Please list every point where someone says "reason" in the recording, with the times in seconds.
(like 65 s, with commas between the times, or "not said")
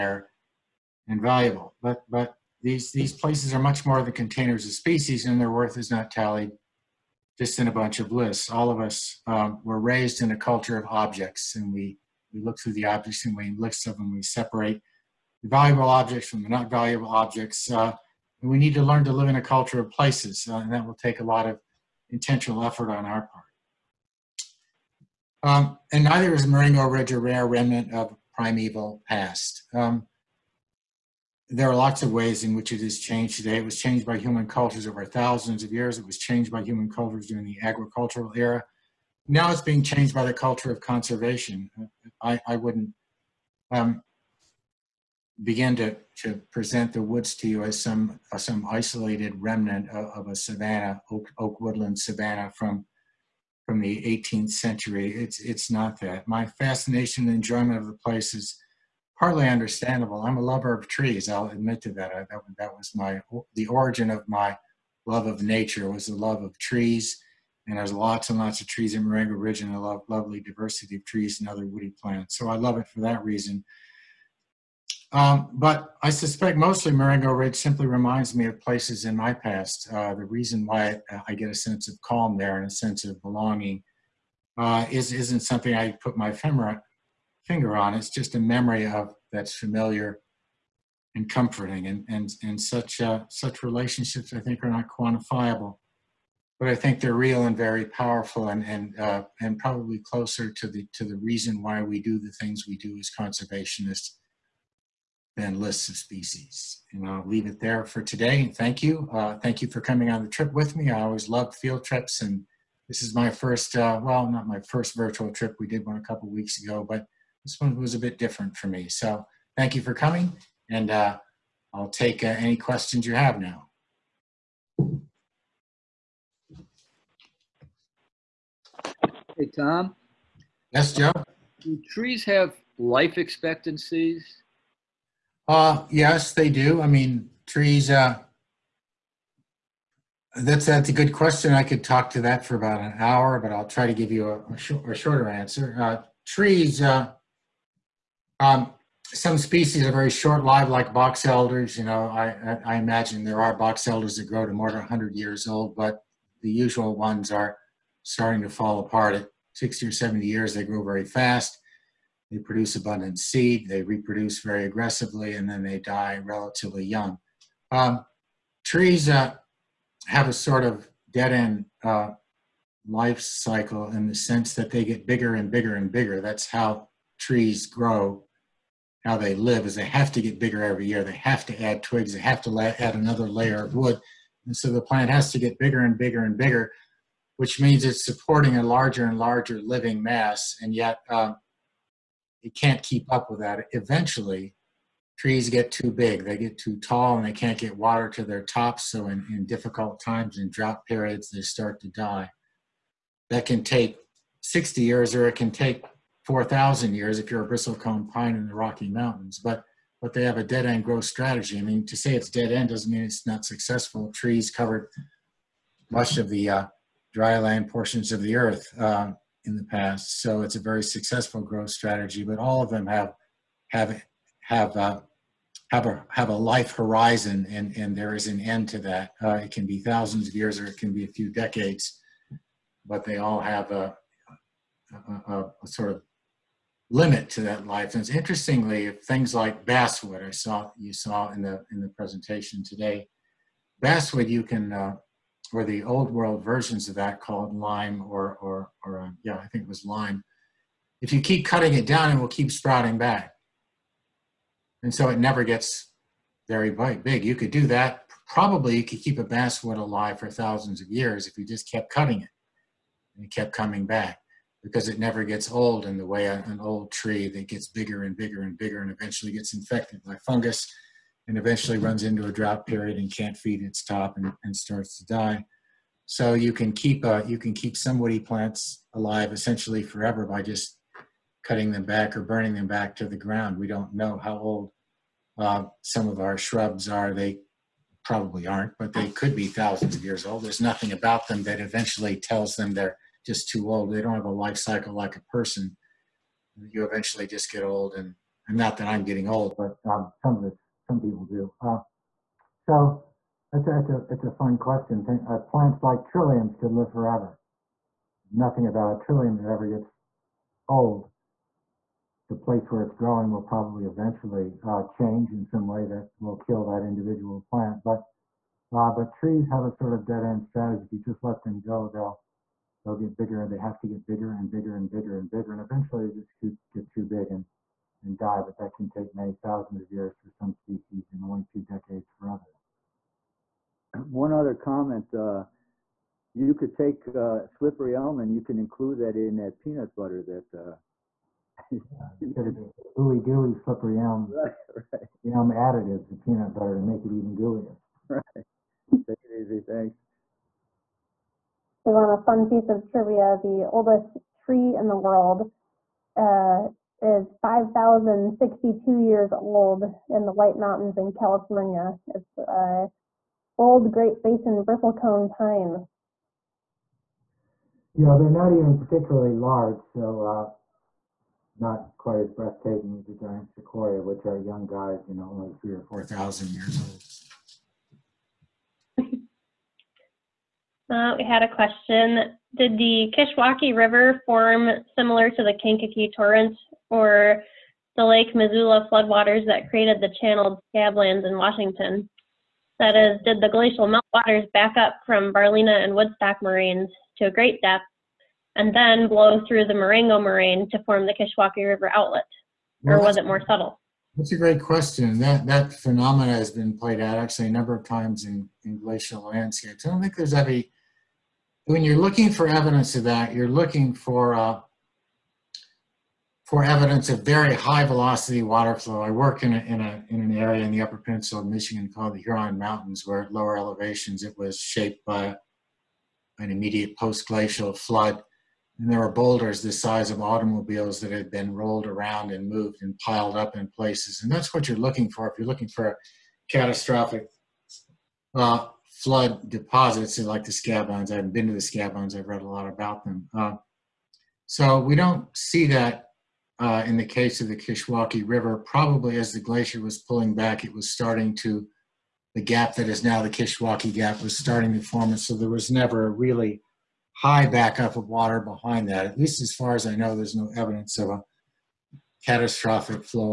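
73 s, 80 s, 101 s.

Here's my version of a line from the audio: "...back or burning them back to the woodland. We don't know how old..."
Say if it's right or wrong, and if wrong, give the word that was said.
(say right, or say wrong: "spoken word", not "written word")
wrong: "ground", not "woodland".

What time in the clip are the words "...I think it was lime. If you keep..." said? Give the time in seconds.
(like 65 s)
249 s.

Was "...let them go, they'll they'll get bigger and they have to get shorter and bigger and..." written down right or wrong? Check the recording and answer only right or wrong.
wrong.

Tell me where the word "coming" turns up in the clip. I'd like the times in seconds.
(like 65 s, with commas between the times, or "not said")
109 s, 119 s, 263 s.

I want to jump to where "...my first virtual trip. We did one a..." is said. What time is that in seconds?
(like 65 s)
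114 s.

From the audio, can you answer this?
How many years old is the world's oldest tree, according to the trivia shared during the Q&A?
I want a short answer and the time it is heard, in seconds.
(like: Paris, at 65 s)
5,062, at 357 s.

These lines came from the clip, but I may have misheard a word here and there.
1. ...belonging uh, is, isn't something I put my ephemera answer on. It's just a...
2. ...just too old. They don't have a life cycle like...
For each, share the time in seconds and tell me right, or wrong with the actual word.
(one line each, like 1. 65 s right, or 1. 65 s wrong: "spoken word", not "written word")
1. 83 s wrong: "finger", not "answer"
2. 293 s right.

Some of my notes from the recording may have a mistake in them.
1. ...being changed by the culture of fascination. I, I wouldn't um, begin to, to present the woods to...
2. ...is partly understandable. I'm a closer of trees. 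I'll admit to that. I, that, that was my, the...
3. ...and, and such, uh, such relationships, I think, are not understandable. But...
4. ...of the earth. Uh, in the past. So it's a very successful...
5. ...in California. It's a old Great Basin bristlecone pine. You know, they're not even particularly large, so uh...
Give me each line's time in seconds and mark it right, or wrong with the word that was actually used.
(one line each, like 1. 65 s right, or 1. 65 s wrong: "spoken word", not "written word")
1. 39 s wrong: "conservation", not "fascination"
2. 58 s wrong: "lover", not "closer"
3. 92 s wrong: "quantifiable", not "understandable"
4. 218 s right
5. 360 s right.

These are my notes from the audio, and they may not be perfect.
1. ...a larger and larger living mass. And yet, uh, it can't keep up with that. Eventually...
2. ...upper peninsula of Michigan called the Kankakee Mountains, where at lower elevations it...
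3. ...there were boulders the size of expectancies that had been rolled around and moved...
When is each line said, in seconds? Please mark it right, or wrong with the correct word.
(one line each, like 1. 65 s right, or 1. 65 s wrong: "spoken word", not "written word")
1. 188 s right
2. 420 s wrong: "Huron", not "Kankakee"
3. 428 s wrong: "automobiles", not "expectancies".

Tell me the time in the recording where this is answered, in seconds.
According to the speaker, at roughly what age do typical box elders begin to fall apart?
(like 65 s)
159 s.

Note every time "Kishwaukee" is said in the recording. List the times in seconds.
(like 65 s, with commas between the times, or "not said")
383 s, 401 s, 447 s, 453 s.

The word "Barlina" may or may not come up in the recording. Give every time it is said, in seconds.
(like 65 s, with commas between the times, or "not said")
395 s.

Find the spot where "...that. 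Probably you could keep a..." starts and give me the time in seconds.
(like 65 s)
257 s.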